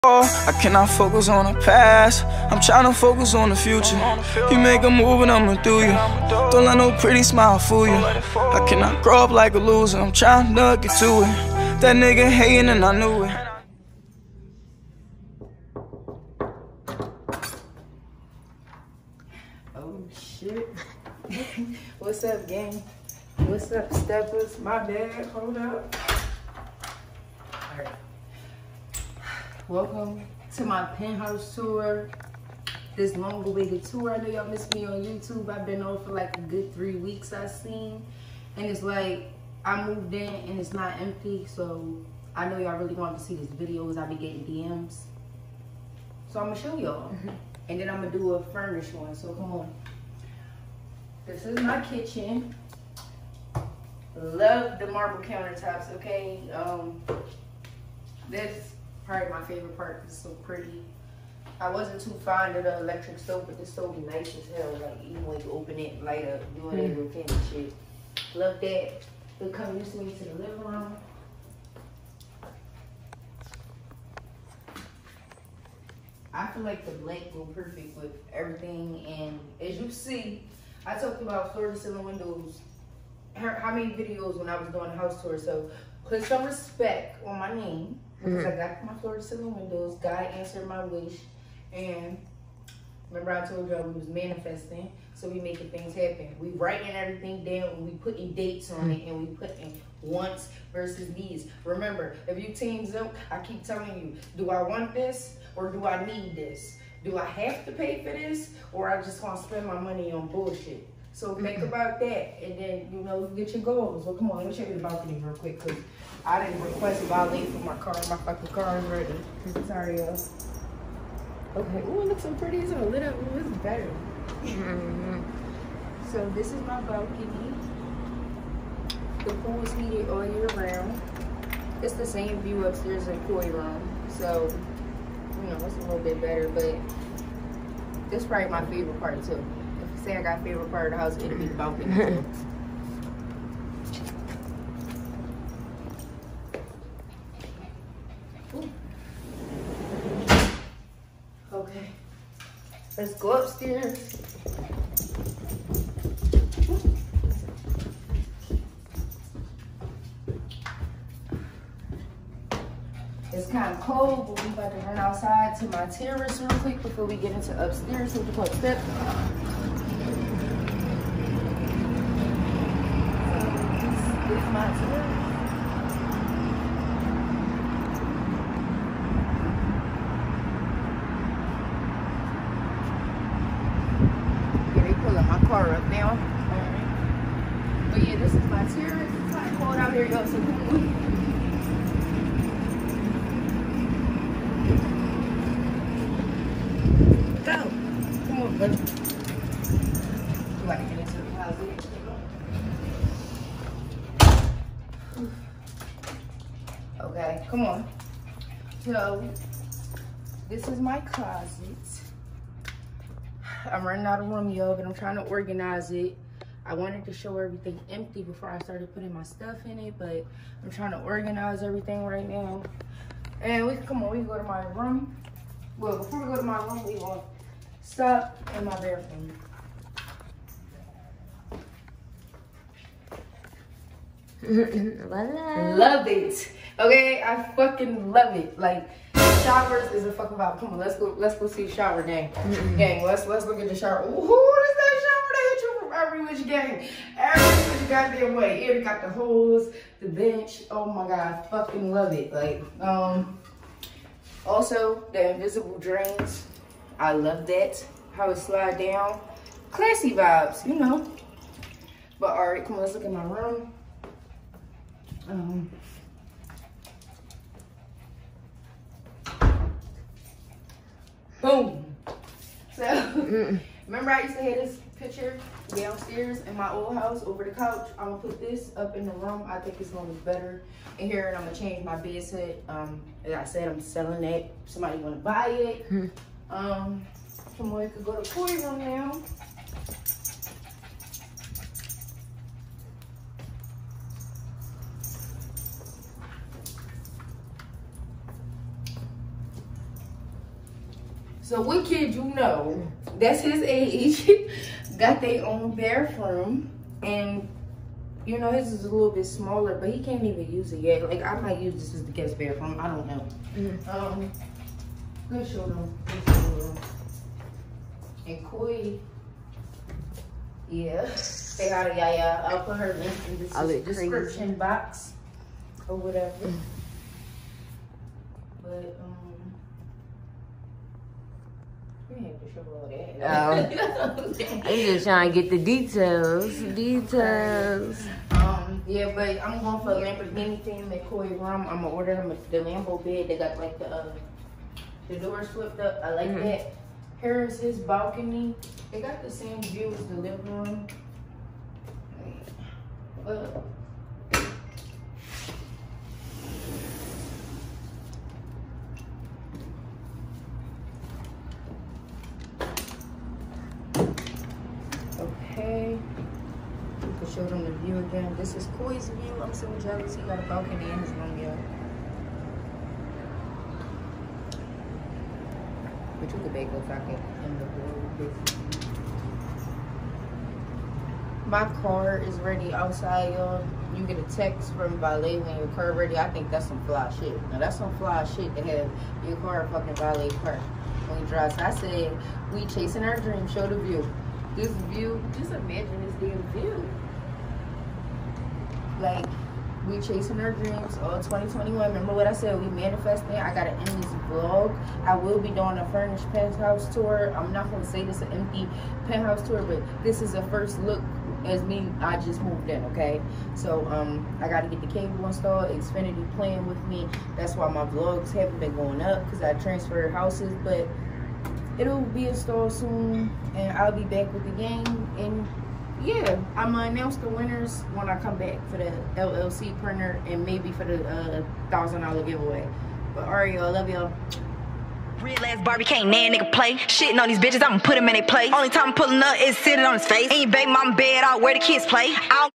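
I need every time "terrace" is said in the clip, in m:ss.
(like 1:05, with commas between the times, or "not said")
2:45, 3:08.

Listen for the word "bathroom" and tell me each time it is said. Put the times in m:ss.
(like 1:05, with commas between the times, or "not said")
3:48, 5:05, 5:12.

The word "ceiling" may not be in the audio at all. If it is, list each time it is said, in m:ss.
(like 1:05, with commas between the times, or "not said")
1:21, 1:29.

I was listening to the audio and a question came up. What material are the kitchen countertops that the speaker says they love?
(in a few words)
Marble.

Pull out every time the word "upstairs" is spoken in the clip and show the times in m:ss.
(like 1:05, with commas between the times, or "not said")
2:12, 2:33, 2:47.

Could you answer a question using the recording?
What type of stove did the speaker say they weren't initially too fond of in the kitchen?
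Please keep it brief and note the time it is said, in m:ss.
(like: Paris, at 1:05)
Electric stove, at 1:02.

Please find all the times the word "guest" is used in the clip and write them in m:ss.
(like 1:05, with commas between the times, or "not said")
5:12.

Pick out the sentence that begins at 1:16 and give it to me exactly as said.
I feel like the blank go perfect with everything.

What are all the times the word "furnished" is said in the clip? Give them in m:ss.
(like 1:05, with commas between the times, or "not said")
0:48, 6:45.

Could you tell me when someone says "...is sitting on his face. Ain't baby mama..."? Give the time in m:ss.
7:19.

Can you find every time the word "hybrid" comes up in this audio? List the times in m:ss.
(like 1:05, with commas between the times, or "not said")
not said.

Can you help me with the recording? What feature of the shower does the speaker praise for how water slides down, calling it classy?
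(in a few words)
Invisible drains.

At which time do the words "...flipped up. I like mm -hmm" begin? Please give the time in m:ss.
5:45.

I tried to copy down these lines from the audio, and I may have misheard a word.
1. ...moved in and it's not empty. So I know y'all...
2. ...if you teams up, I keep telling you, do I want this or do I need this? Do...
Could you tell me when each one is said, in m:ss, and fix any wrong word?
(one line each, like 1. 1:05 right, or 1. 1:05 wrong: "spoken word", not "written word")
1. 0:39 right
2. 1:42 right.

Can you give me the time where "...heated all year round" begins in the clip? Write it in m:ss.
2:09.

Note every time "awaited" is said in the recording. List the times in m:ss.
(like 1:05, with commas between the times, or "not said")
0:33.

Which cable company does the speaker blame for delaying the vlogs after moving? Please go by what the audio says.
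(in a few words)
Xfinity.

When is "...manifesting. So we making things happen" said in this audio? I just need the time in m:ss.
1:34.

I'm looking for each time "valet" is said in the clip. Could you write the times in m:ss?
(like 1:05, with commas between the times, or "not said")
6:24, 6:29.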